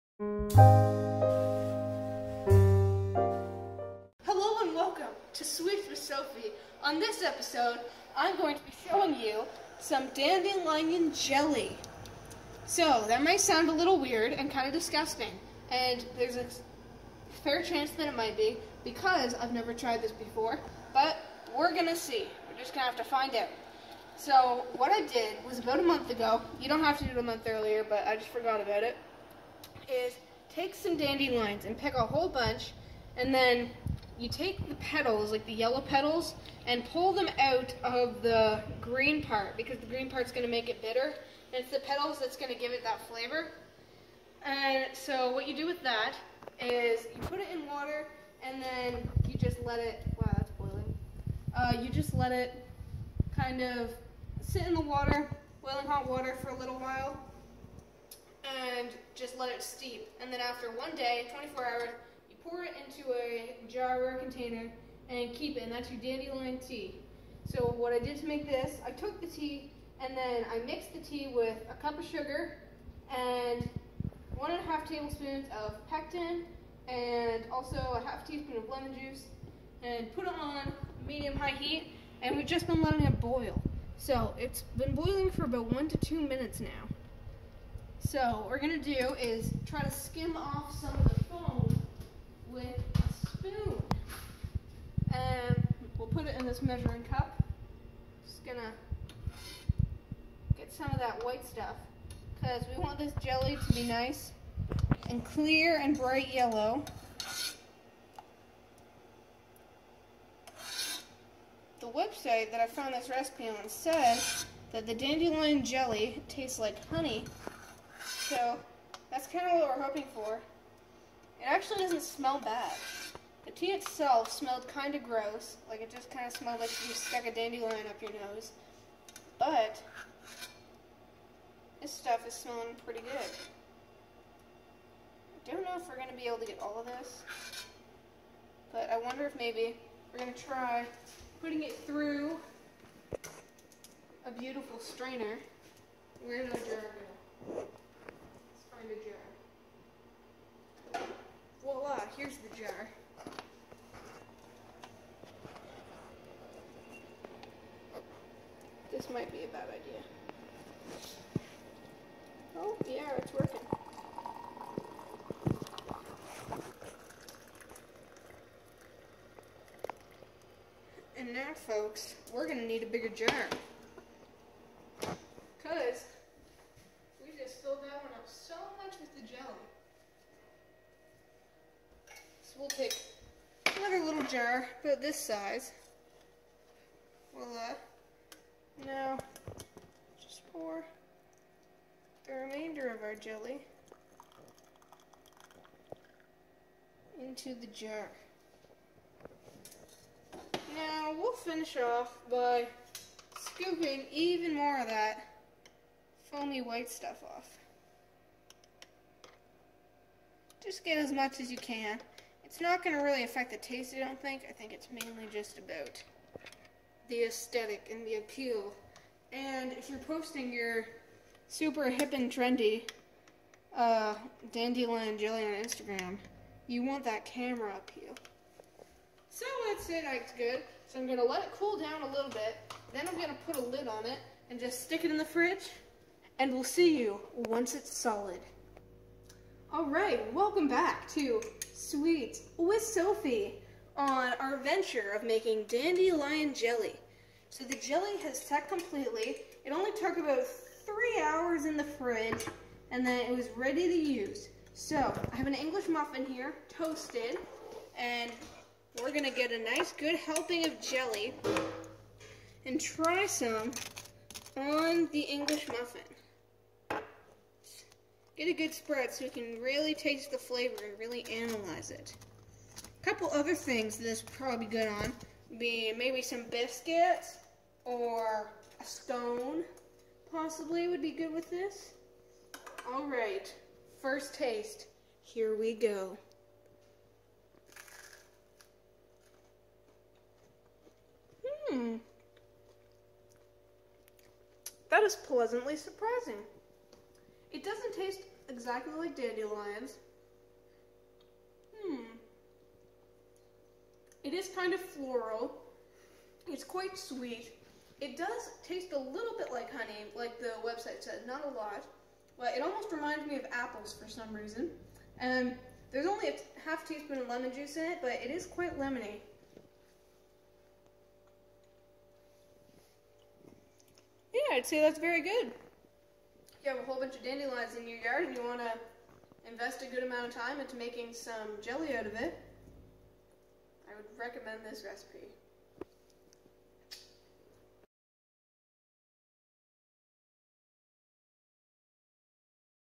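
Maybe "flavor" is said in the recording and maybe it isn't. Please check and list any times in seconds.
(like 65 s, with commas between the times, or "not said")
43 s, 270 s.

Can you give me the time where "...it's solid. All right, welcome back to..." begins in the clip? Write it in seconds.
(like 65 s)
237 s.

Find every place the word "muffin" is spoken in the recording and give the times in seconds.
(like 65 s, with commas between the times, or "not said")
255 s, 265 s.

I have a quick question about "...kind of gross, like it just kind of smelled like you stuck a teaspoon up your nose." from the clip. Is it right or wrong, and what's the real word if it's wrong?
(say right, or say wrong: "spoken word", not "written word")
wrong: "dandelion", not "teaspoon".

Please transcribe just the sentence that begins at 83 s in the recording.
So it's been boiling for about one to two minutes now.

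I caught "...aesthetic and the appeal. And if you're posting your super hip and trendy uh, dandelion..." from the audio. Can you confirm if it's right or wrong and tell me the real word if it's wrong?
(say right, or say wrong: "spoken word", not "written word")
right.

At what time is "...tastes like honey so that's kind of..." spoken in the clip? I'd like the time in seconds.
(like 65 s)
116 s.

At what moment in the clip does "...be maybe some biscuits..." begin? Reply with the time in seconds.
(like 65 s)
275 s.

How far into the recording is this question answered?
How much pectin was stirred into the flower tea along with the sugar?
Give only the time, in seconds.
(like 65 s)
74 s.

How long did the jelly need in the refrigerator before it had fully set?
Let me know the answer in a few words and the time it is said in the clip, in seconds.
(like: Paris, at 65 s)
3 hours, at 250 s.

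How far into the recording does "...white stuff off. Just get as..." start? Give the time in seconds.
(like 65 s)
206 s.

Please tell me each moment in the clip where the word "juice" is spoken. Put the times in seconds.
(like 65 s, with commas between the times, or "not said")
78 s, 317 s.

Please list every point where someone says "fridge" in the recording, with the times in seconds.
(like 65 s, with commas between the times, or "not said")
235 s, 251 s.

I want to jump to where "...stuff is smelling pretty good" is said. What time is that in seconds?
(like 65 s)
131 s.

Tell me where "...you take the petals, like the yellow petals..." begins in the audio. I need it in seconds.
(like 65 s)
34 s.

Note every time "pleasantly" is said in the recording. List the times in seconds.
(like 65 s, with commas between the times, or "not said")
295 s.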